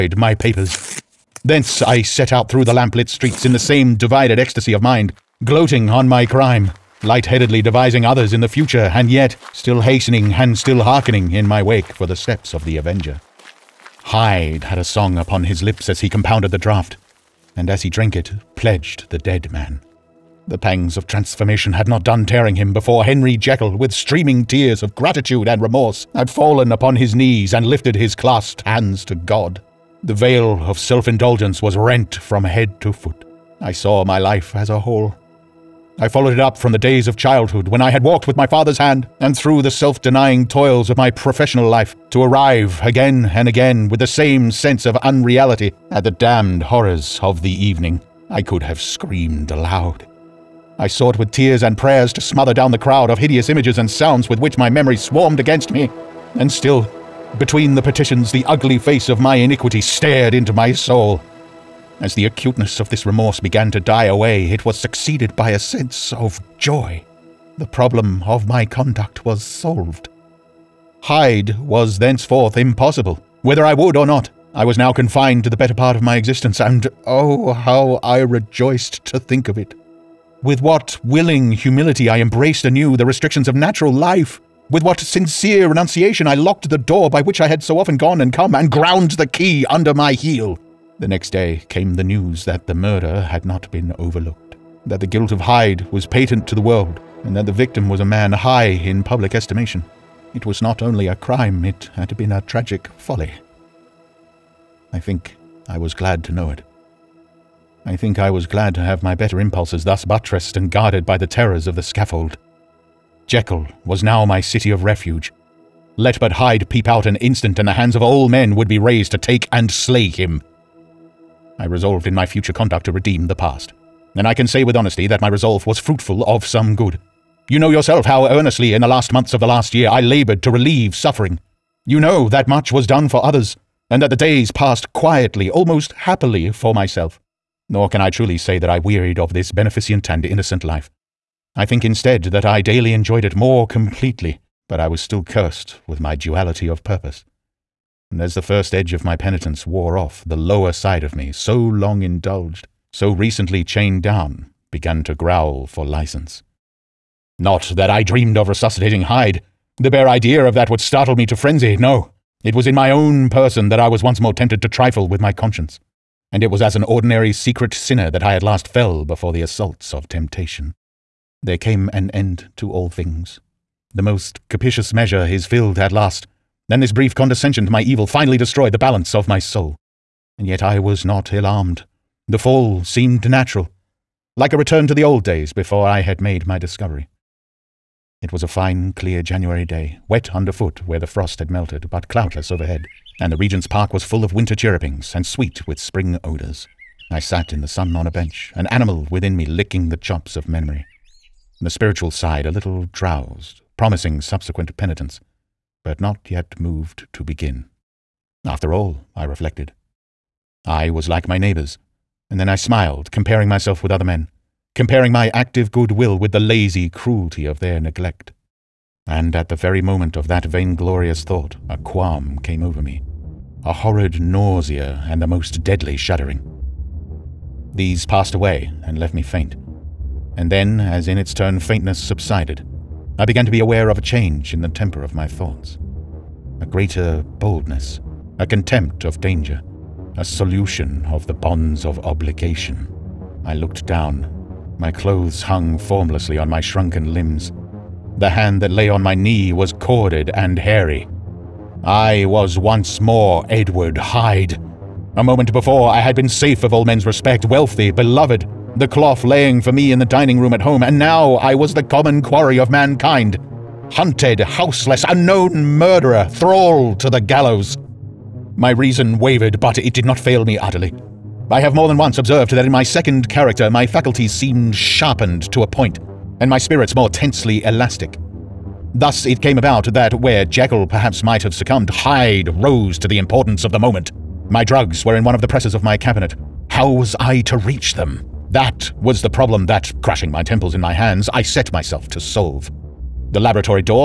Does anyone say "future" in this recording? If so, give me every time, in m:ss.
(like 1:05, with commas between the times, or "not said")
0:08, 2:02.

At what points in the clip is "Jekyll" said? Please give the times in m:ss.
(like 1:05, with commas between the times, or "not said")
0:23, 1:53, 4:40.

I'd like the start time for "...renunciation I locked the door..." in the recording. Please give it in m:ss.
1:25.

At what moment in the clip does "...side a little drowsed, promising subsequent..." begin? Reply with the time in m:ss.
3:22.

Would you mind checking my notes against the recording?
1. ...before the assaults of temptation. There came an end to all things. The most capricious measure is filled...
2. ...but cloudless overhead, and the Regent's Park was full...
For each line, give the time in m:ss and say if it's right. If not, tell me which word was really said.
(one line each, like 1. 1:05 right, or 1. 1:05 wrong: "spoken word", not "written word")
1. 2:49 right
2. 3:11 right.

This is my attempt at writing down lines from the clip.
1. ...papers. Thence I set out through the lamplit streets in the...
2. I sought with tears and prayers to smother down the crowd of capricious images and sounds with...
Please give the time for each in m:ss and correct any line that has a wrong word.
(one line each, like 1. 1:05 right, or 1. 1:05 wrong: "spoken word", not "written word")
1. 0:00 right
2. 0:50 wrong: "hideous", not "capricious".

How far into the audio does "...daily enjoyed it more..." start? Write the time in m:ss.
2:22.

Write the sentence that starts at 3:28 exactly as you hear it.
After all, I reflected, I was like my neighbors.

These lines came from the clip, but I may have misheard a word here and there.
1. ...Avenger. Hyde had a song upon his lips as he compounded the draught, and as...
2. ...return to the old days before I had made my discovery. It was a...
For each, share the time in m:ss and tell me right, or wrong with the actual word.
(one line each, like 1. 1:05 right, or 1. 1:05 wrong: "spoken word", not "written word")
1. 0:12 right
2. 3:04 right.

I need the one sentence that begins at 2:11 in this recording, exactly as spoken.
You know that much was done for others, and that the days passed quietly, almost happily, for myself.